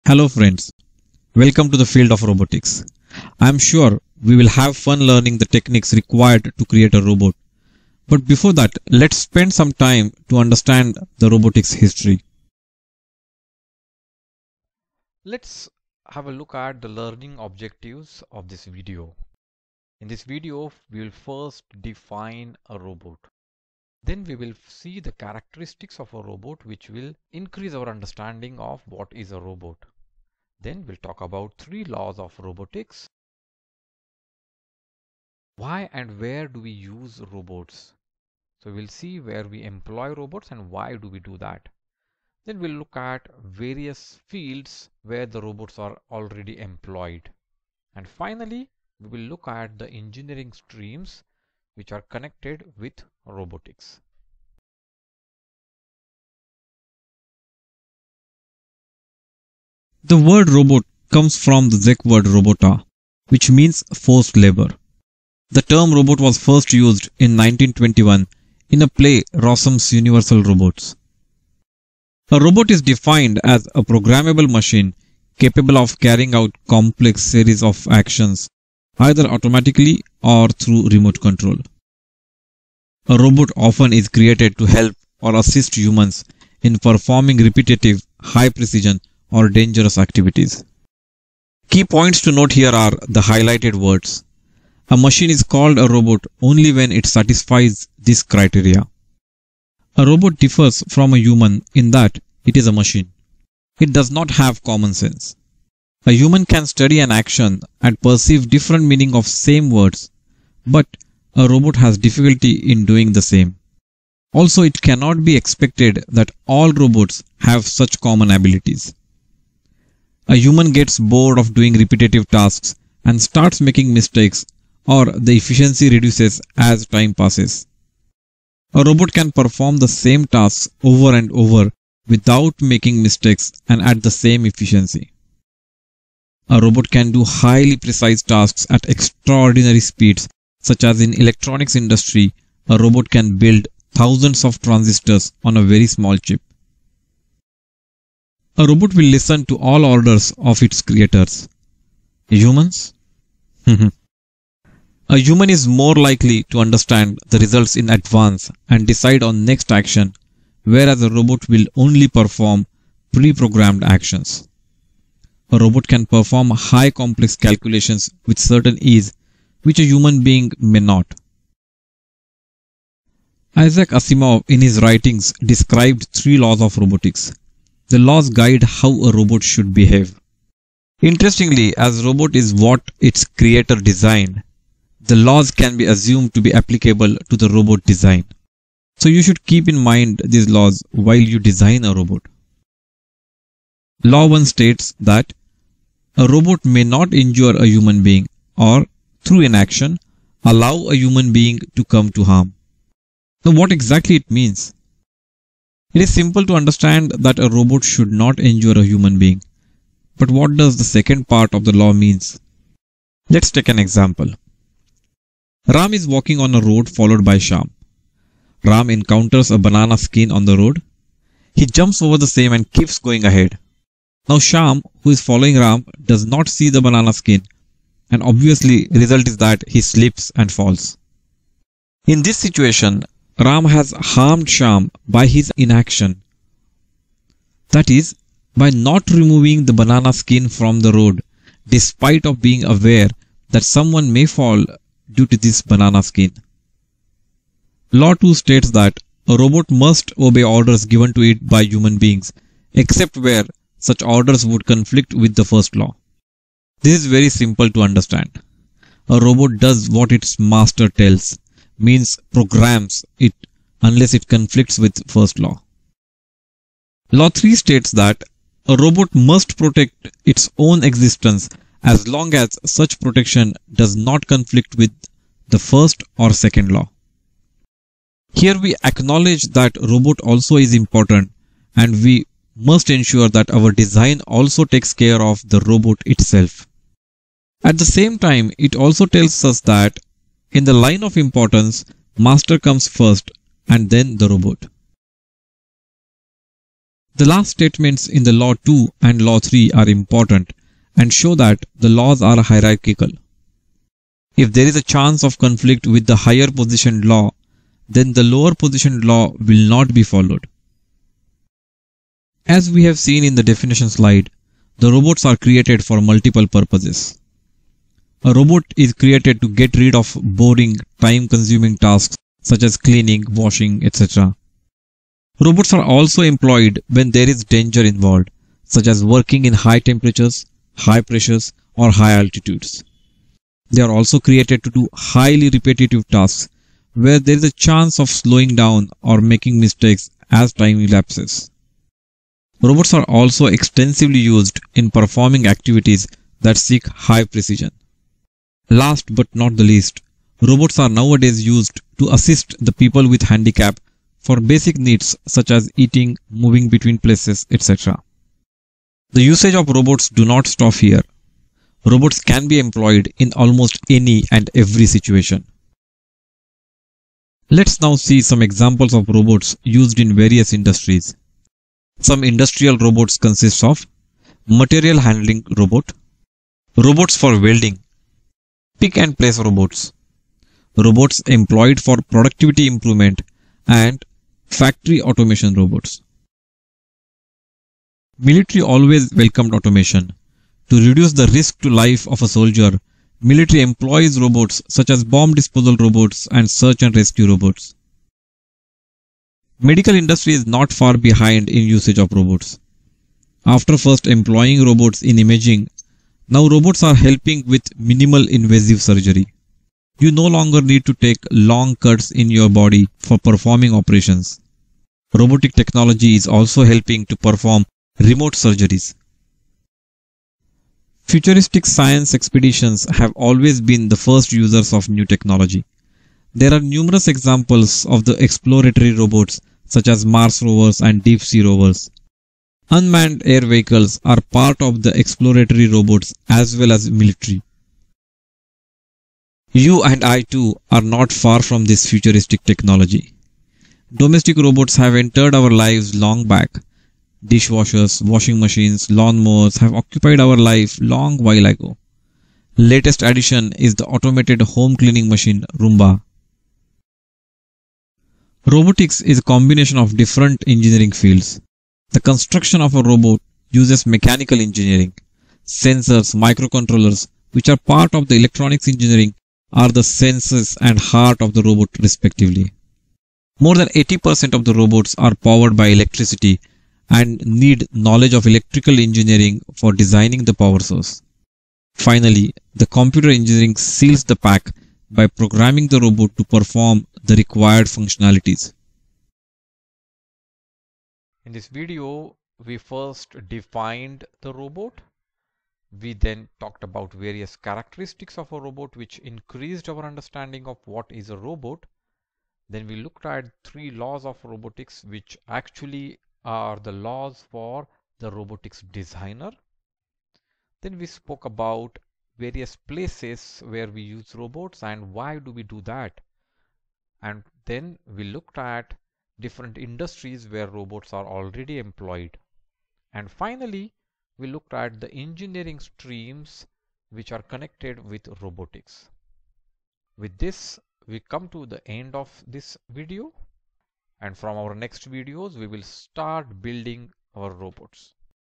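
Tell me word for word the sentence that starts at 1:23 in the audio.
A robot often is created to help or assist humans in performing repetitive, high precision or dangerous activities.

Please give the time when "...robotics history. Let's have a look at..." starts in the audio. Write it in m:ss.
0:11.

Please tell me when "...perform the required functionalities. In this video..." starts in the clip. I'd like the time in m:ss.
8:06.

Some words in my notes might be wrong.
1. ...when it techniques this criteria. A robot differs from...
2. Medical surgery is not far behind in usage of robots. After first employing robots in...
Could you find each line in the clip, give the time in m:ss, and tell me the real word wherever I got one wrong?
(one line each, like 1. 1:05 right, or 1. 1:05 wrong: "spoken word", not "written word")
1. 1:36 wrong: "satisfies", not "techniques"
2. 6:39 wrong: "industry", not "surgery".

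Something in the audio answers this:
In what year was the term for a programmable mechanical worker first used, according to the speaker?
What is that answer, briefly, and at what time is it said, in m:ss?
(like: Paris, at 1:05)
1921, at 1:07.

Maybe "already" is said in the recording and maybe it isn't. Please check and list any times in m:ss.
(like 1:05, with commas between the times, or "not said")
0:46, 8:41.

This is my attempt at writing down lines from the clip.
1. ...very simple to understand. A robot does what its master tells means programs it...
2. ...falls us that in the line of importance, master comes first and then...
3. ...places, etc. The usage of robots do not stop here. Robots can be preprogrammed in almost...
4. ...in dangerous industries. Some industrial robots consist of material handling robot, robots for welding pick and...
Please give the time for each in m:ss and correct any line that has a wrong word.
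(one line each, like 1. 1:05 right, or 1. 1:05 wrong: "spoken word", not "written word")
1. 4:17 right
2. 4:49 wrong: "tells", not "falls"
3. 5:56 wrong: "employed", not "preprogrammed"
4. 6:09 wrong: "various", not "dangerous".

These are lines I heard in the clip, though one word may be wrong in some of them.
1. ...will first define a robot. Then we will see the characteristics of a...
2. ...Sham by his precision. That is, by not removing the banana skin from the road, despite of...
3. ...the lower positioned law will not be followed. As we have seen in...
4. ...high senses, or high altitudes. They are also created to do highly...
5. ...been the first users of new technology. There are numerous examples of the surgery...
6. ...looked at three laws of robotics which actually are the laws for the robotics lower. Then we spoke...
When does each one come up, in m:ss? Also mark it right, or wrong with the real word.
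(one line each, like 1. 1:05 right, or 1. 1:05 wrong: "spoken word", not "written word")
1. 0:21 right
2. 3:54 wrong: "inaction", not "precision"
3. 5:08 right
4. 5:30 wrong: "pressures", not "senses"
5. 7:03 wrong: "exploratory", not "surgery"
6. 8:22 wrong: "designer", not "lower".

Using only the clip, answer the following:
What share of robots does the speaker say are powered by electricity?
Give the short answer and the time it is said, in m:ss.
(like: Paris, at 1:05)
more than 80%, at 7:53.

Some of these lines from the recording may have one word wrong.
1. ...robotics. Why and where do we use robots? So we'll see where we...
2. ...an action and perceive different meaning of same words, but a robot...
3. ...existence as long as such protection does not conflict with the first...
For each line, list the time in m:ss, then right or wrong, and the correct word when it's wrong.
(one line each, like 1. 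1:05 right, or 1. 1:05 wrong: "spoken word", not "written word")
1. 0:32 right
2. 1:46 right
3. 4:30 right.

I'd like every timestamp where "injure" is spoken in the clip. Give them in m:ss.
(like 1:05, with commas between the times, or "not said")
3:17, 3:28.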